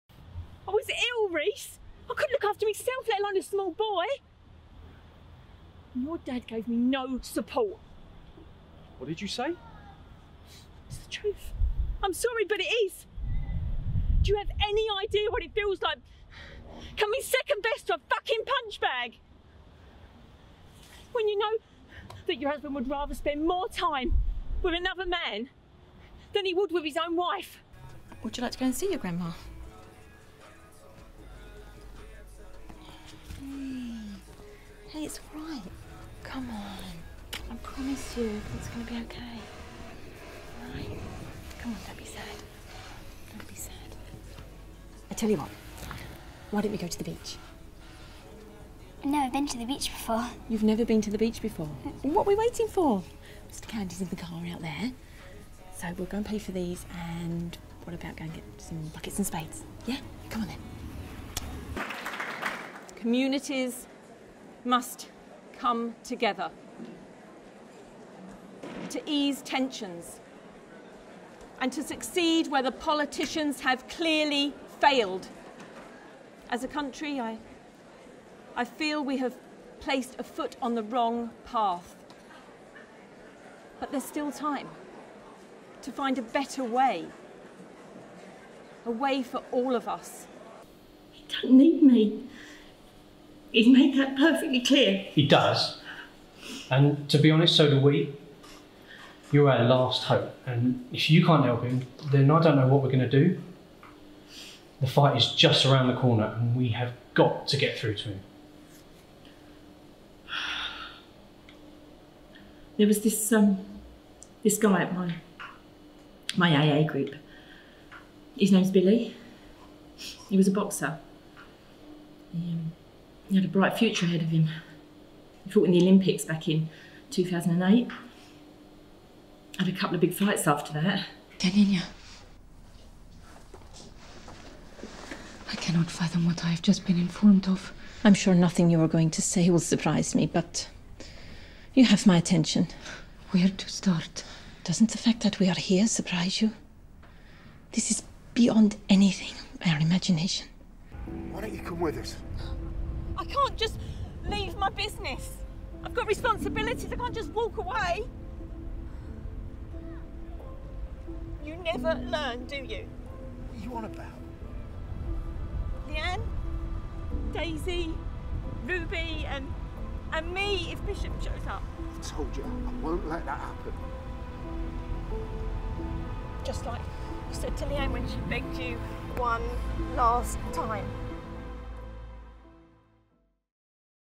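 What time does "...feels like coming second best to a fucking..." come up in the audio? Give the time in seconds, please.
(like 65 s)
15 s.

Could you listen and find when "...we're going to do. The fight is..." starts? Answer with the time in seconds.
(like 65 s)
102 s.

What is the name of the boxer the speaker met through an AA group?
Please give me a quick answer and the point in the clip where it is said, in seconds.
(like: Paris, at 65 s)
Billy, at 118 s.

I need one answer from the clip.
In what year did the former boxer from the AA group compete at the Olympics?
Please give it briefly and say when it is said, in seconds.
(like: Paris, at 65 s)
2008, at 127 s.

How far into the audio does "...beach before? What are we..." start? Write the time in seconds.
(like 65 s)
51 s.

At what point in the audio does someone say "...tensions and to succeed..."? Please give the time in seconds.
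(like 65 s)
69 s.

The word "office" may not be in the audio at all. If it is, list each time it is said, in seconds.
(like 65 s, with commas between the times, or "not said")
not said.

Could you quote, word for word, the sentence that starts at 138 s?
I'm sure nothing you are going to say will surprise me, but you have my attention.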